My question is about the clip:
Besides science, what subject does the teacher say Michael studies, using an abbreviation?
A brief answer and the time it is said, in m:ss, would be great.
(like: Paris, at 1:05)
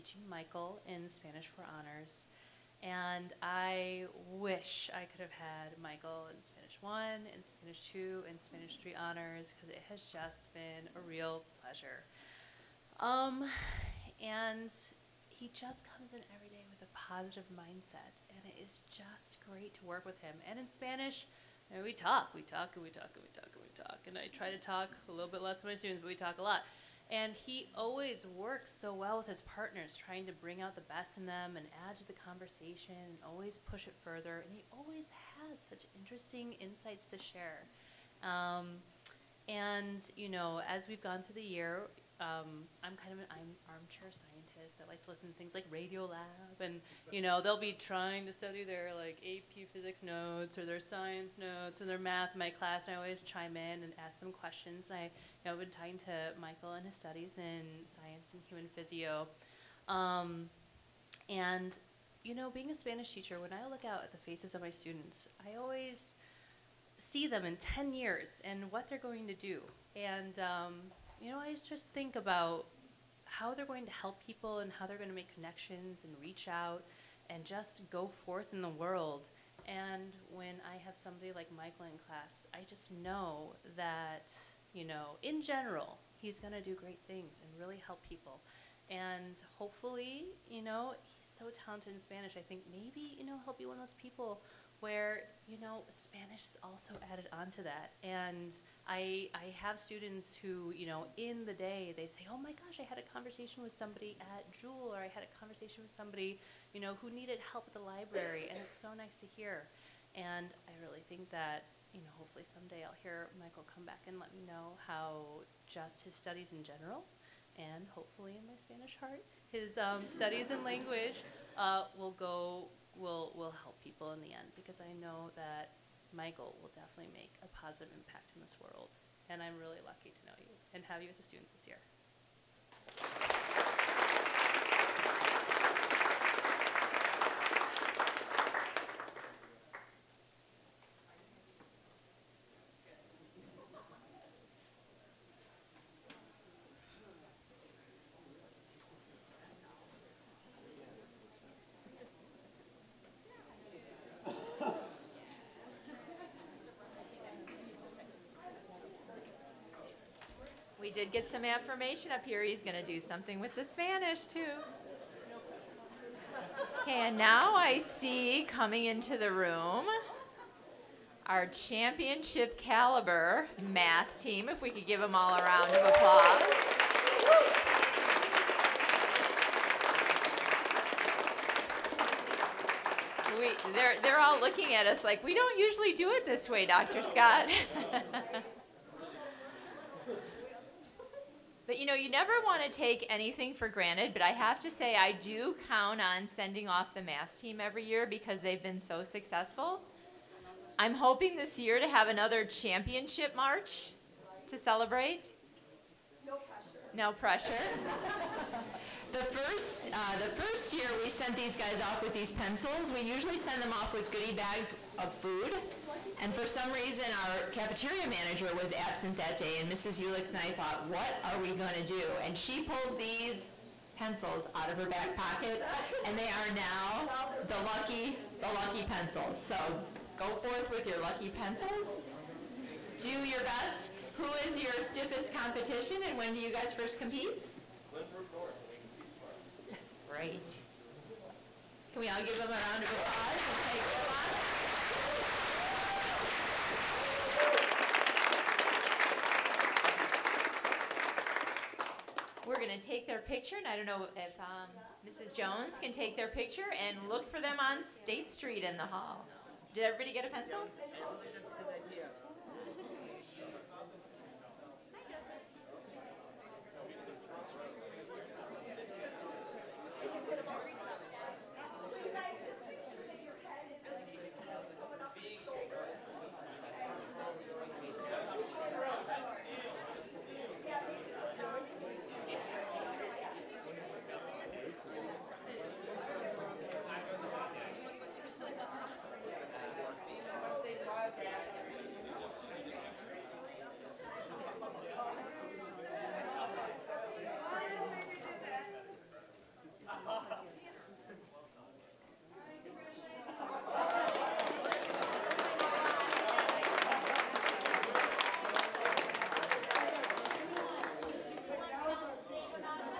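human physio, at 0:58.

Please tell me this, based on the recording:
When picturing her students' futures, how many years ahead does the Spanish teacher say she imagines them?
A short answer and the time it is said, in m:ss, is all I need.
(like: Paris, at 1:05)
10, at 1:07.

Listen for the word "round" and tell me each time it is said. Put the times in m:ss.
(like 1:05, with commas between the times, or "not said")
2:55, 4:02.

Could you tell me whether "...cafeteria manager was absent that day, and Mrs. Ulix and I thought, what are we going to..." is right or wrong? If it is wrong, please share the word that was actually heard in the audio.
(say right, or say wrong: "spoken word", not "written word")
right.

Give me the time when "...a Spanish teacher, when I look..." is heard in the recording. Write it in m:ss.
1:02.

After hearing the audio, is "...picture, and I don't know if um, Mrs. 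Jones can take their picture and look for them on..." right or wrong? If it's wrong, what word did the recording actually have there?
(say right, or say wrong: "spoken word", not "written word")
right.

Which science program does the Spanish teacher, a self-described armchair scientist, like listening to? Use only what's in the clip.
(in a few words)
Radiolab.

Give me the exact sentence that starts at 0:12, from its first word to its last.
Um, and he just comes in every day with a positive mindset, and it is just great to work with him.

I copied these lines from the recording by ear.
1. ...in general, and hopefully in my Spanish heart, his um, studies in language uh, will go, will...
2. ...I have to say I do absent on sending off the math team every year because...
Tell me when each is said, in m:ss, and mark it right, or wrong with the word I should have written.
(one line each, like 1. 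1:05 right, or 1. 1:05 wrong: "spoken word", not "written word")
1. 1:56 right
2. 3:14 wrong: "count", not "absent".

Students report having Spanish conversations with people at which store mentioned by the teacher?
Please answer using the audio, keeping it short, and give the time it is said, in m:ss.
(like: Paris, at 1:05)
Jewel, at 1:44.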